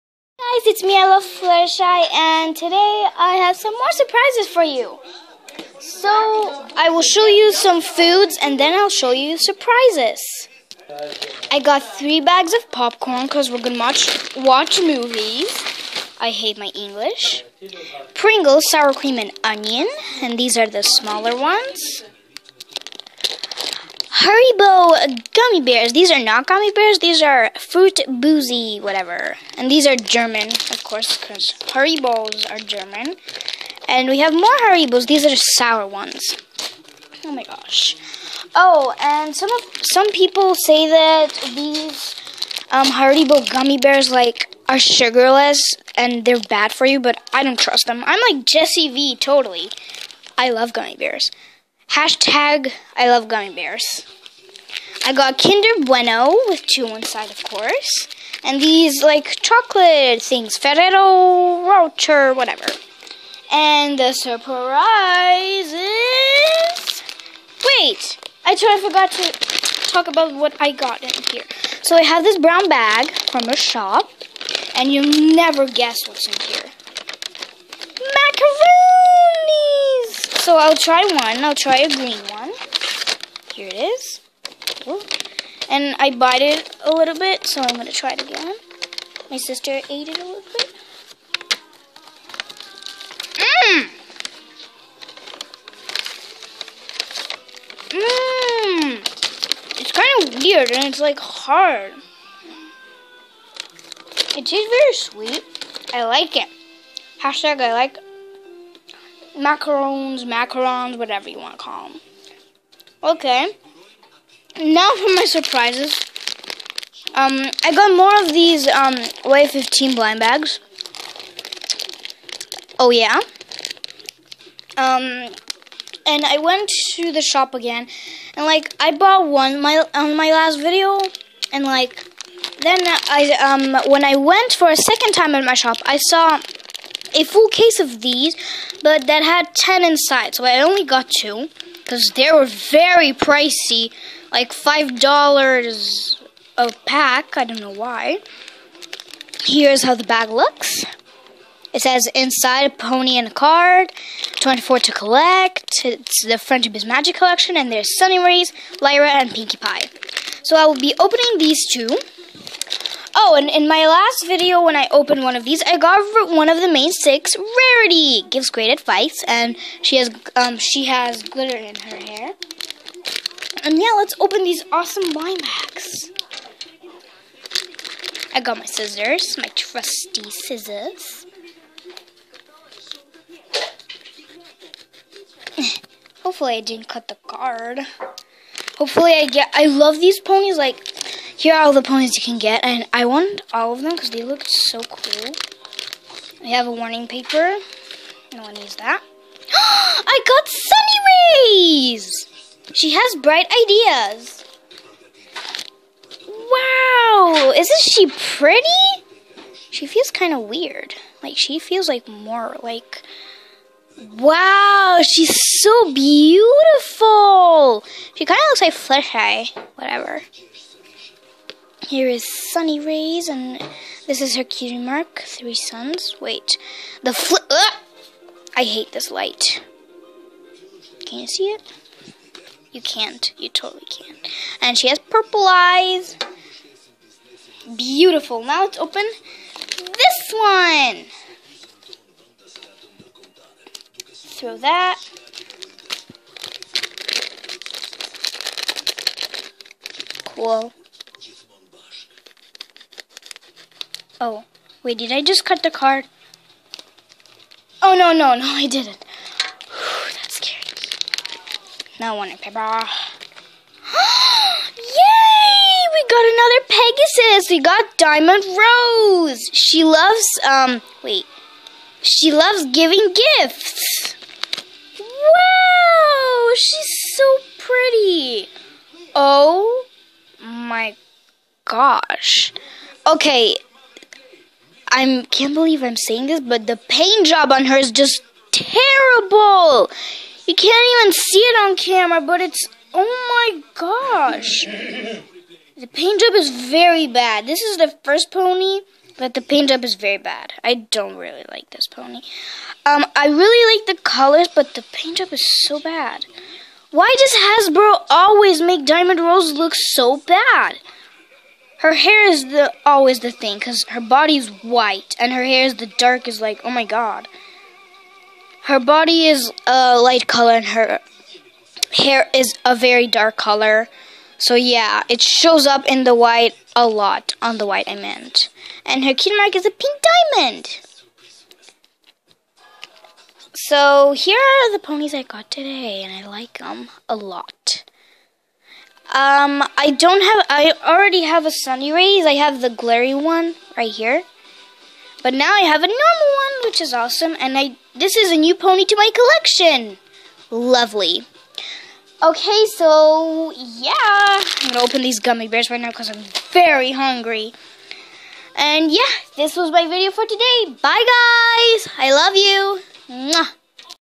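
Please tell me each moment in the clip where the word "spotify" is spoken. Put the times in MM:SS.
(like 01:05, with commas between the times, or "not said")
not said.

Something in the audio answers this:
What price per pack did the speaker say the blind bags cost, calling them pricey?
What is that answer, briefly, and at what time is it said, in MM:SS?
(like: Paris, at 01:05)
$5, at 02:24.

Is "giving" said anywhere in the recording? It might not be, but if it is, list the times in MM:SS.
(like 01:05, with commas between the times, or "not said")
04:32.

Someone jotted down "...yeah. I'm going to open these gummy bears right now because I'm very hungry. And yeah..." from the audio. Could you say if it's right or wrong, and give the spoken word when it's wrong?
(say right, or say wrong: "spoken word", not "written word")
right.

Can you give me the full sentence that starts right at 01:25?
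And I bite it a little bit, so I'm going to try it again.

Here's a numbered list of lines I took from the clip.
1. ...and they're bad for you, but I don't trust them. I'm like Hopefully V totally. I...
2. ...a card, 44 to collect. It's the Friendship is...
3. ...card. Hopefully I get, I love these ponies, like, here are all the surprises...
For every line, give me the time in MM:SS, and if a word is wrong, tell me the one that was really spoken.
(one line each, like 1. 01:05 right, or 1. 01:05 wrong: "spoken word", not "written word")
1. 00:45 wrong: "Jesse", not "Hopefully"
2. 02:33 wrong: "24", not "44"
3. 03:07 wrong: "ponies", not "surprises".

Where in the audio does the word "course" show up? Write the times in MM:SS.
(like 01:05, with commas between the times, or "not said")
00:30, 00:57.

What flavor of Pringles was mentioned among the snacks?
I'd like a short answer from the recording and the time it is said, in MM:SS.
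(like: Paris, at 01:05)
Sour cream and onion, at 00:18.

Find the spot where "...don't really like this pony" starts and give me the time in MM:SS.
05:00.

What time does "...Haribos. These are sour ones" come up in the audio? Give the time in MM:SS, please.
00:34.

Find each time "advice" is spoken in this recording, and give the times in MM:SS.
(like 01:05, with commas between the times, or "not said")
02:48.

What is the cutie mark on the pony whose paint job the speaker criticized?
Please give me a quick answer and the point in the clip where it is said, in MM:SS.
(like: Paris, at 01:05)
Pink diamond, at 05:29.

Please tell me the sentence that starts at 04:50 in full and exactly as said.
You can't even see it on camera, but it's oh my gosh.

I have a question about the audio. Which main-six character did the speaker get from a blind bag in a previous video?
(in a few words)
Rarity.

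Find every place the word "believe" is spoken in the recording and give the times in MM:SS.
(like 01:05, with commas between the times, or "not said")
04:45.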